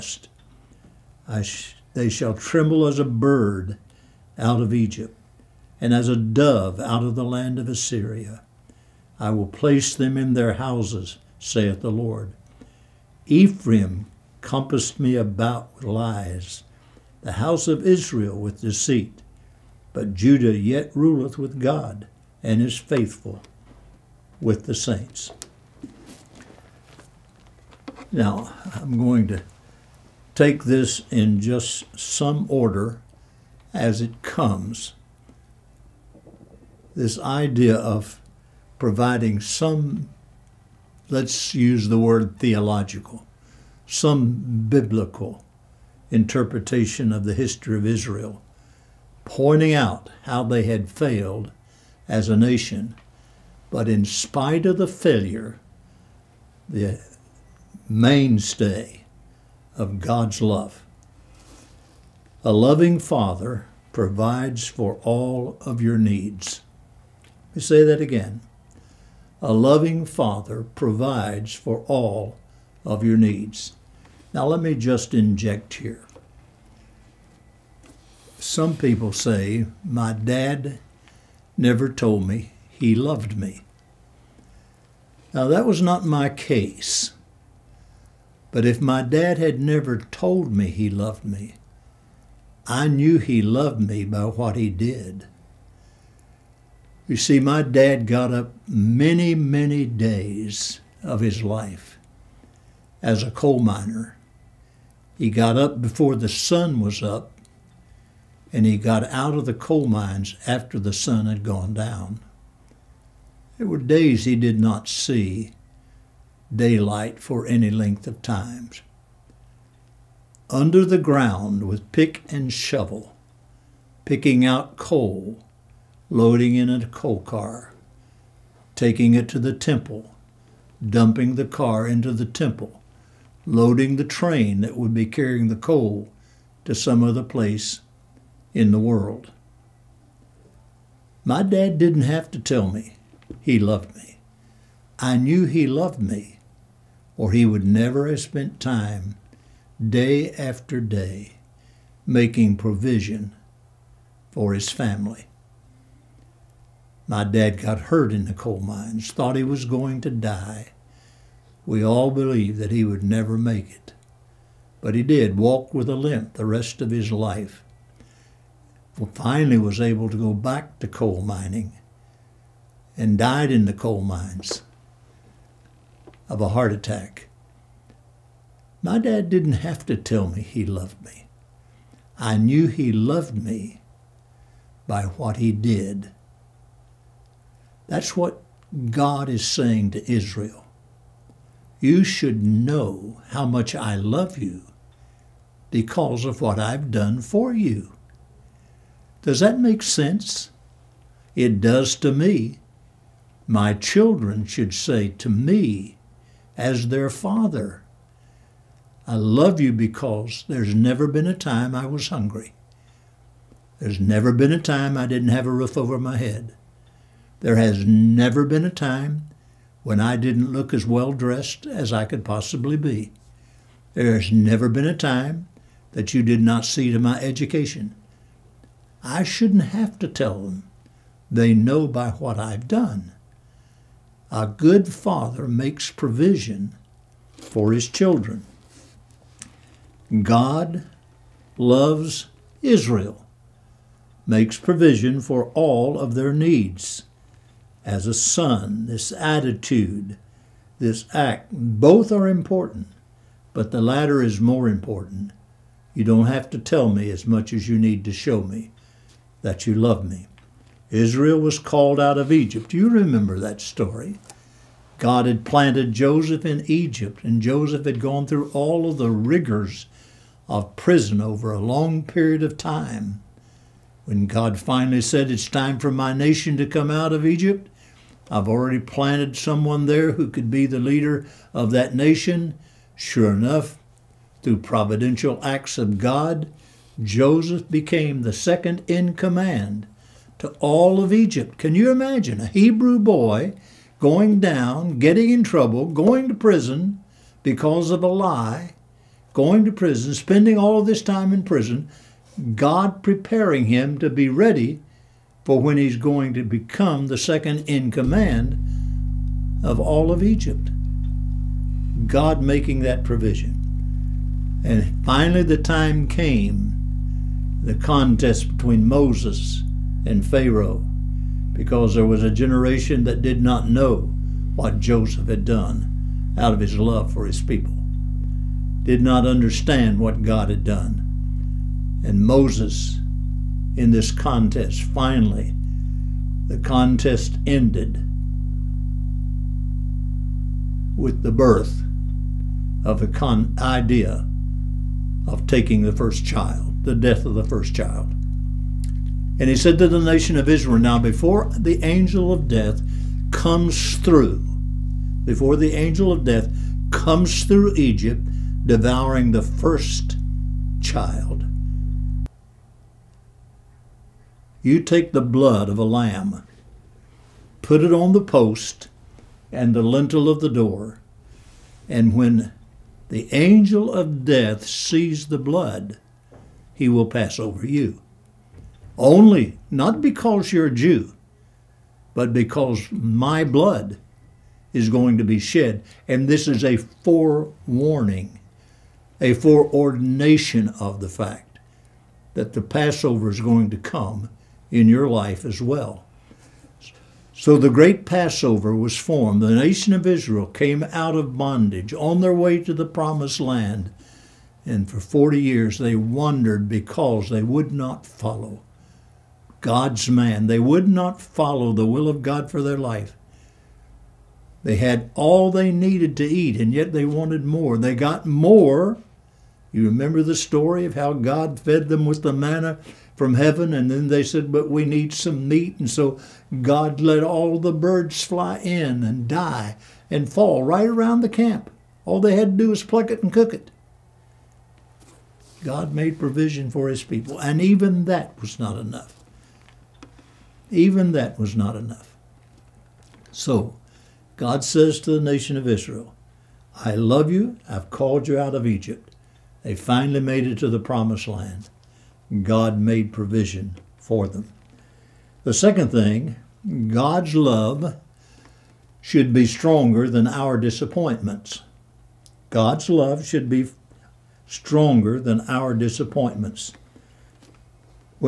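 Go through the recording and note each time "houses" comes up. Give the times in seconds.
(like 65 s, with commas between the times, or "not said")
10 s, 17 s.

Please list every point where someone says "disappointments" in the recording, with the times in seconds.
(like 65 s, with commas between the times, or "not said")
460 s, 465 s.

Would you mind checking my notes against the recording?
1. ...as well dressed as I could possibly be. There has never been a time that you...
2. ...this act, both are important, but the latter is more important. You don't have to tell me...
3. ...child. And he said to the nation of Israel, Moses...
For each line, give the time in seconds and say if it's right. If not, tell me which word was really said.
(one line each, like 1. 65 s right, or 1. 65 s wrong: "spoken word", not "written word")
1. 220 s right
2. 250 s right
3. 347 s wrong: "Now", not "Moses".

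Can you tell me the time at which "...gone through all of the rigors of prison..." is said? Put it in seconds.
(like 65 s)
267 s.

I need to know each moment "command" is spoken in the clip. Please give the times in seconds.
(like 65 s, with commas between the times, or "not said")
289 s, 307 s.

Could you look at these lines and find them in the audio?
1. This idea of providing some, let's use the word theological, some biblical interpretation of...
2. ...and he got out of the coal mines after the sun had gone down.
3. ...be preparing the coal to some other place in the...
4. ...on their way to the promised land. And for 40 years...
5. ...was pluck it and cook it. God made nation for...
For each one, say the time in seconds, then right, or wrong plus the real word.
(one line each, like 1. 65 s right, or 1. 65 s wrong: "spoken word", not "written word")
1. 36 s right
2. 108 s right
3. 134 s wrong: "carrying", not "preparing"
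4. 401 s right
5. 432 s wrong: "provision", not "nation".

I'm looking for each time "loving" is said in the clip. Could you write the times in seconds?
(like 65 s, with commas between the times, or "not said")
62 s, 69 s.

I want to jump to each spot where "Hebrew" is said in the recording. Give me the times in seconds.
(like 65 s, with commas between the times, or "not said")
292 s.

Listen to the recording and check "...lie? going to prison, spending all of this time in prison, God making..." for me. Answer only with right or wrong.
wrong.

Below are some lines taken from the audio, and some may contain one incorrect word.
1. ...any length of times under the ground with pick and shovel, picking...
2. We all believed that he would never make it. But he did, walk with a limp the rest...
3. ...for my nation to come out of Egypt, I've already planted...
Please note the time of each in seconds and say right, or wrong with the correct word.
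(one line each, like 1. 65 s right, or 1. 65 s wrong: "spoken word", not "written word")
1. 117 s right
2. 161 s right
3. 275 s right.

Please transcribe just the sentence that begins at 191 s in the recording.
You should know how much I love you because of what I've done for you.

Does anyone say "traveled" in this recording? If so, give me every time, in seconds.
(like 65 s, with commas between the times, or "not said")
not said.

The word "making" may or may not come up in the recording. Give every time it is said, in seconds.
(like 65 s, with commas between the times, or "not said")
152 s, 312 s.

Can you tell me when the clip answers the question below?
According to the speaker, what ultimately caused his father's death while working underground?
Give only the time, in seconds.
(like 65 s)
176 s.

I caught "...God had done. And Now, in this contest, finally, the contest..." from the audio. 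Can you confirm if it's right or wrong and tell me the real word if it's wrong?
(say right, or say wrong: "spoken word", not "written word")
wrong: "Moses", not "Now".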